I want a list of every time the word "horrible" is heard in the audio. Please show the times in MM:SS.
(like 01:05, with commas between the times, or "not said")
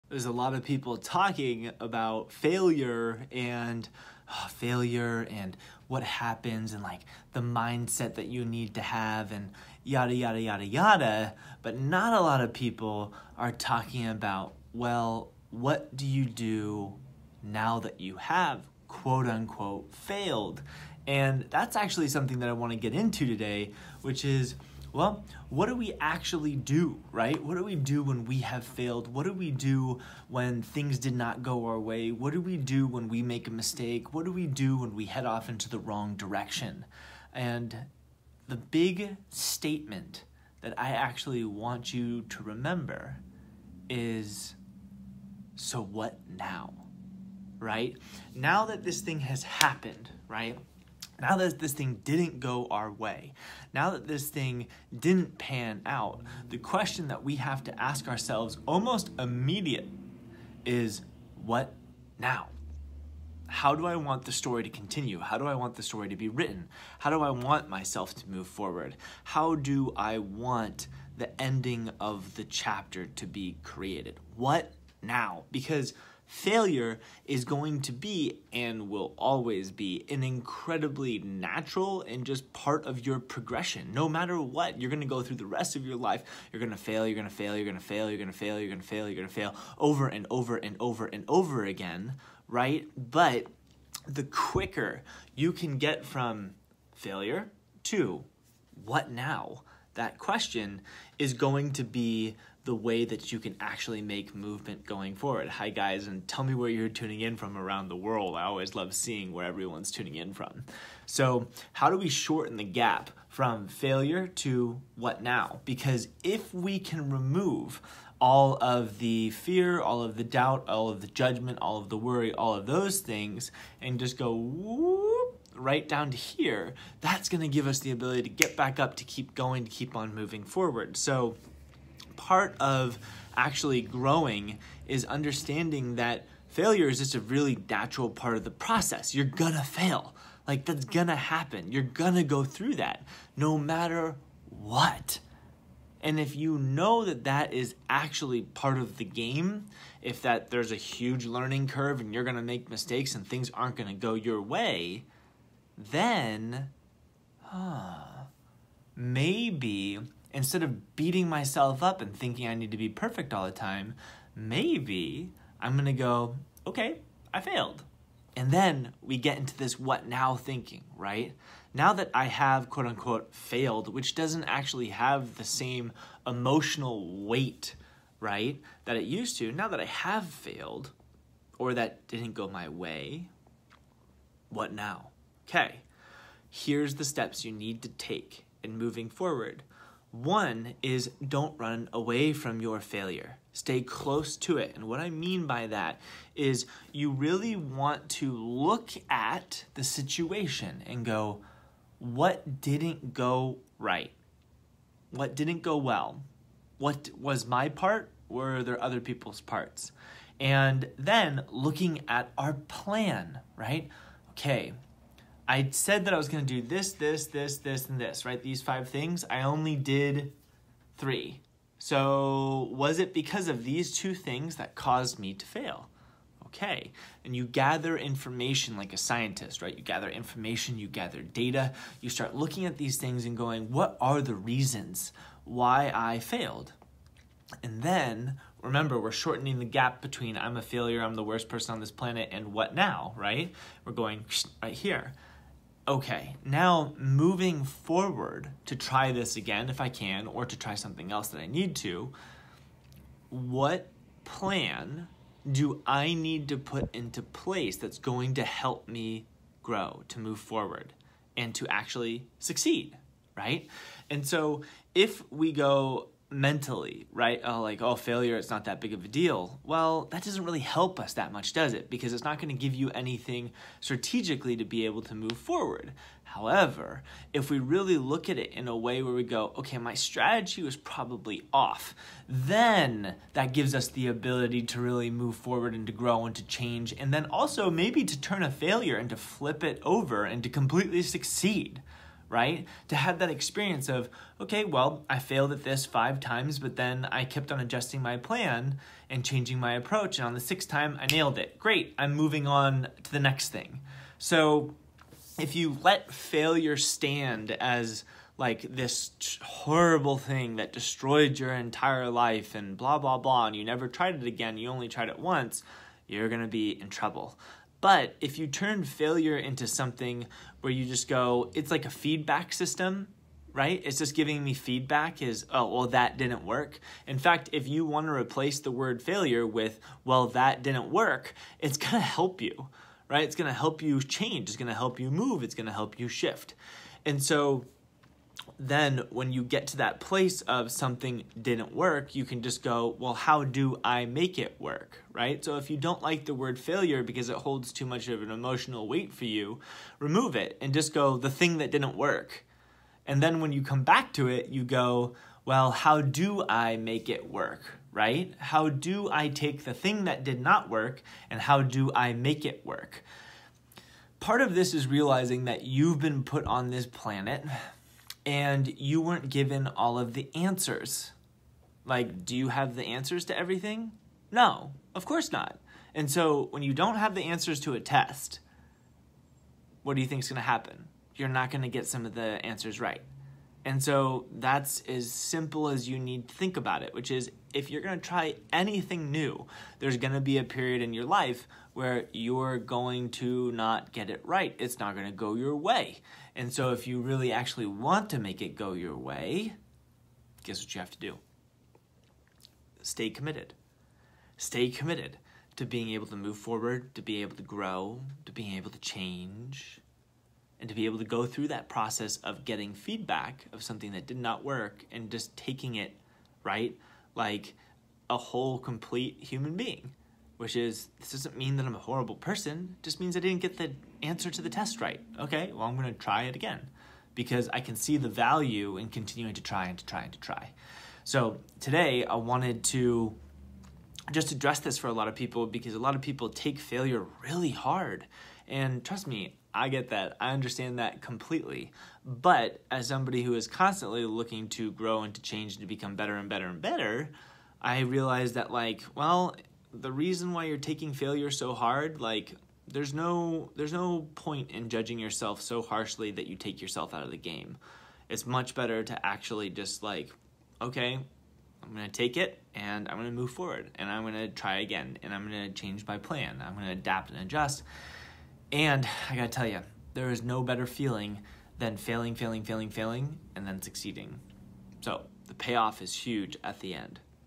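05:09, 07:01.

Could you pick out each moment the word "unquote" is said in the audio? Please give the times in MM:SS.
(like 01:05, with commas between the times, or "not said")
00:19, 02:52.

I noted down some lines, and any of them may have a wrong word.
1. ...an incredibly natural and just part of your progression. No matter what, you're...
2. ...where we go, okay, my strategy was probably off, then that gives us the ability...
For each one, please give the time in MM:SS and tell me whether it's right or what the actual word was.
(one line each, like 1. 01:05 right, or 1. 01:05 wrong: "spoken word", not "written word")
1. 01:20 right
2. 04:39 right.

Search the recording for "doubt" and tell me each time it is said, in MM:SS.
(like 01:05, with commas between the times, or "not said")
02:00.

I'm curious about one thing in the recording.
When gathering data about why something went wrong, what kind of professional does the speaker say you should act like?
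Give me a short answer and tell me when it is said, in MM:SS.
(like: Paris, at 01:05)
A scientist, at 03:48.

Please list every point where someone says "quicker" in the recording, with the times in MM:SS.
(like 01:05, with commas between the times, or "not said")
01:34.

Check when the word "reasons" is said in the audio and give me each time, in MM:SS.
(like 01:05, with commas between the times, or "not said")
03:54, 07:29.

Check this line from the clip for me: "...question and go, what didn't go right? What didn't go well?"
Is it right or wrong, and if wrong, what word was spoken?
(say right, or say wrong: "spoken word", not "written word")
wrong: "situation", not "question".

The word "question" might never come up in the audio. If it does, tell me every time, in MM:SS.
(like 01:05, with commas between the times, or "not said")
00:56, 01:40.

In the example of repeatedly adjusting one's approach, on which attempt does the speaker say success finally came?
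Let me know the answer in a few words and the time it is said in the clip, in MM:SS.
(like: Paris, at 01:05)
Sixth time, at 05:00.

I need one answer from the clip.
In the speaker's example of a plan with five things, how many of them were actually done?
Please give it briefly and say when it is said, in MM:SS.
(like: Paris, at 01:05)
3, at 03:39.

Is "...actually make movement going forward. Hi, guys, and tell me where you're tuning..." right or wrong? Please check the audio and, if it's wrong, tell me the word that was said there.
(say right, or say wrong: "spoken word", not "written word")
right.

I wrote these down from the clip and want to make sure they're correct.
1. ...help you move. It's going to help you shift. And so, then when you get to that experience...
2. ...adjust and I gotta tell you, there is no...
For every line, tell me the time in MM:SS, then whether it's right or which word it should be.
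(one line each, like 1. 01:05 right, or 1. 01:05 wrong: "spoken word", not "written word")
1. 05:34 wrong: "place", not "experience"
2. 07:47 right.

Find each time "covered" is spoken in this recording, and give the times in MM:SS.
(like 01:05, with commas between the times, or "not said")
not said.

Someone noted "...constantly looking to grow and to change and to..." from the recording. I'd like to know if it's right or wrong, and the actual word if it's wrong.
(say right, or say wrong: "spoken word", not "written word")
right.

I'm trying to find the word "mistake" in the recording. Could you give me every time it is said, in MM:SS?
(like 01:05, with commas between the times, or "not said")
00:33, 02:32.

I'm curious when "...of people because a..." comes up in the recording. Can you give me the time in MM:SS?
07:15.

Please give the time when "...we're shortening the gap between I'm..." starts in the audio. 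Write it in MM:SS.
03:59.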